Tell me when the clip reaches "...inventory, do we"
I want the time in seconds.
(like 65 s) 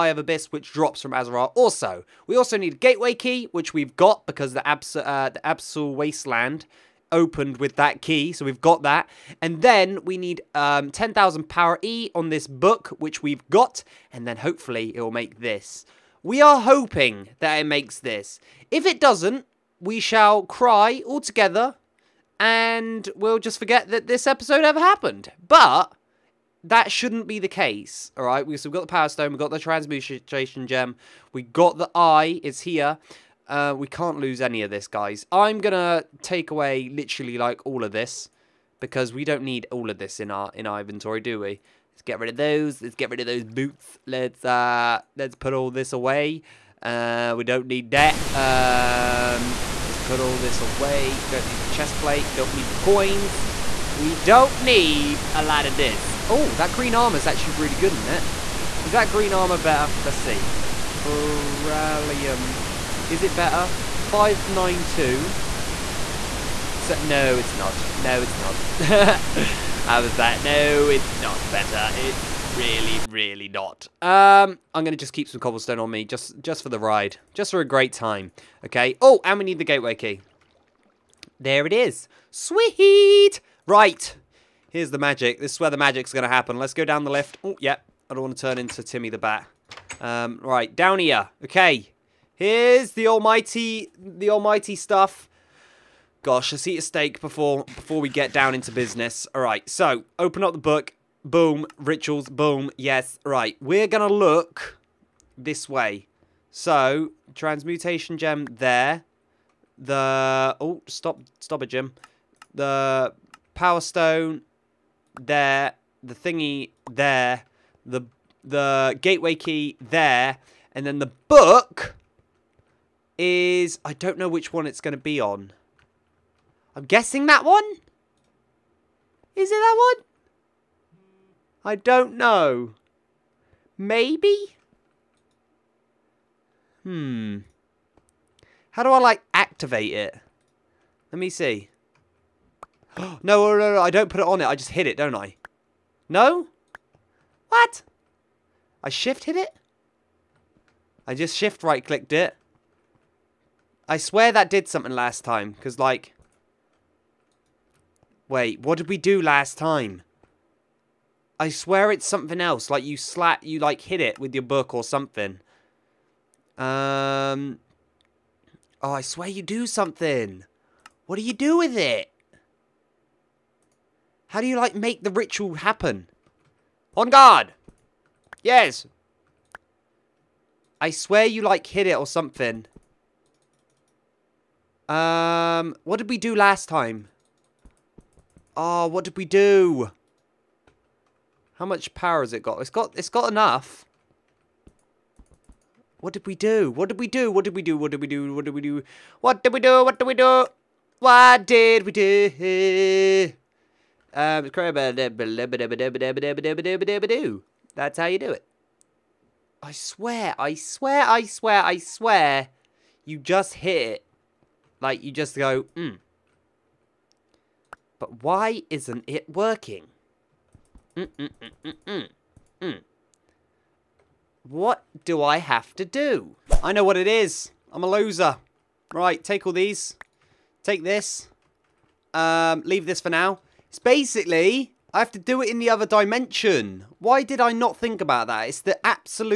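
40 s.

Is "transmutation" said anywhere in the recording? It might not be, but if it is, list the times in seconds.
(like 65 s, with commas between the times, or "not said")
29 s, 107 s.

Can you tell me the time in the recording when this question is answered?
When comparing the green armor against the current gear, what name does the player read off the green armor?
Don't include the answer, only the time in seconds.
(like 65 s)
60 s.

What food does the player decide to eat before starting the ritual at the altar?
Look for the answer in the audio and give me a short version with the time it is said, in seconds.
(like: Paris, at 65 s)
steak, at 96 s.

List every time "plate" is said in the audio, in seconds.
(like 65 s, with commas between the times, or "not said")
51 s.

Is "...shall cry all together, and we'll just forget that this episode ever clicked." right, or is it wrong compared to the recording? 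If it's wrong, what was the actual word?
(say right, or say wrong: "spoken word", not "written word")
wrong: "happened", not "clicked".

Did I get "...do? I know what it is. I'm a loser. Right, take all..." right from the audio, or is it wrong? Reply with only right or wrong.
right.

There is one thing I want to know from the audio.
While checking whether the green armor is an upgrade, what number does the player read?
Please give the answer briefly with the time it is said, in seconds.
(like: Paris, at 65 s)
592, at 63 s.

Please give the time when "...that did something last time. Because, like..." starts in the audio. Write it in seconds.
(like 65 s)
154 s.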